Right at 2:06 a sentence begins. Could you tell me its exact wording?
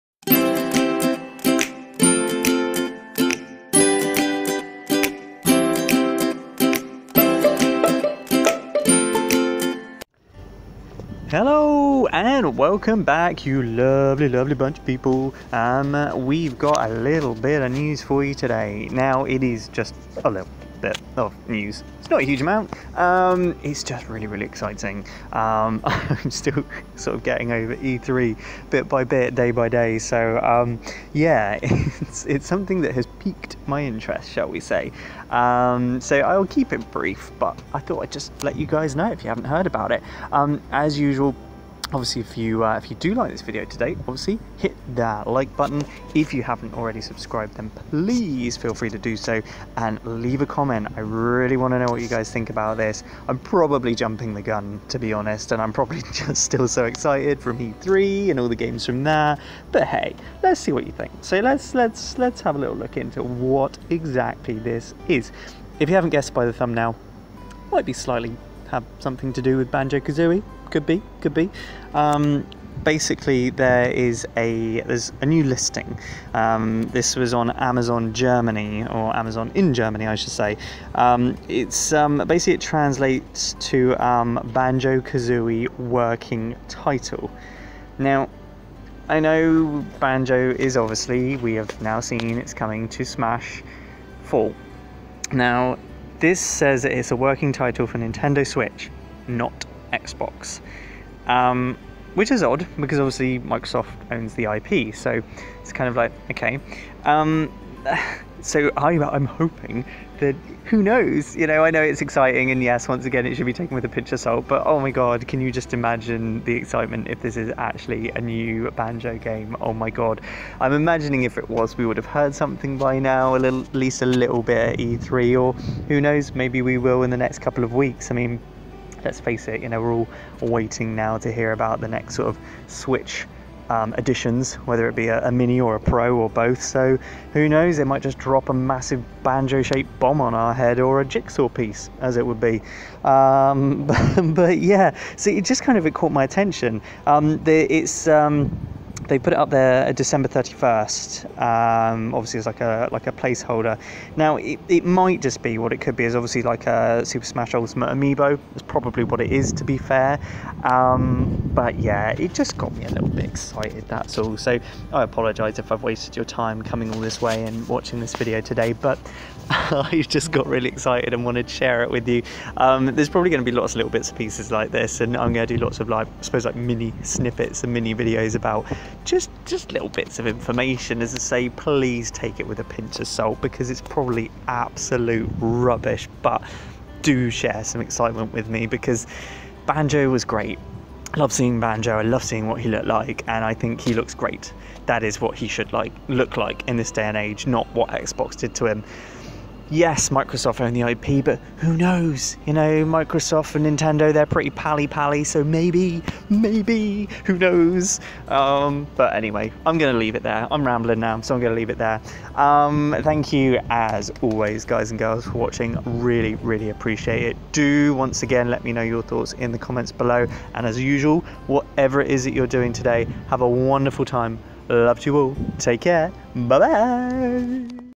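Maybe we will in the next couple of weeks.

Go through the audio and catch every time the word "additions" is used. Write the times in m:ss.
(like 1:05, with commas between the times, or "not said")
2:13.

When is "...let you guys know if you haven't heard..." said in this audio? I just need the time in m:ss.
0:38.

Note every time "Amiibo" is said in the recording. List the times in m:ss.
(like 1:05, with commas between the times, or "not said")
2:37.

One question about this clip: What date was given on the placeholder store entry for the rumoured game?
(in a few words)
December 31st.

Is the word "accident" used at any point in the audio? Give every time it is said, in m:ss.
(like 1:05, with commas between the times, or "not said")
not said.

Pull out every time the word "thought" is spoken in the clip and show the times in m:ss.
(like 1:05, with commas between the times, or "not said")
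0:37, 3:39.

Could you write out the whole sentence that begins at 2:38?
It's probably what it is, to be fair.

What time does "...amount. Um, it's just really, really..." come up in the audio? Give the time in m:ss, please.
0:22.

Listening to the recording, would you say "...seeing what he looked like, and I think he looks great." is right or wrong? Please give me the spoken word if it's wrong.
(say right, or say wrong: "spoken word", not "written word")
right.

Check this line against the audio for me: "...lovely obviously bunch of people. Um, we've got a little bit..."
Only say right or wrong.
wrong.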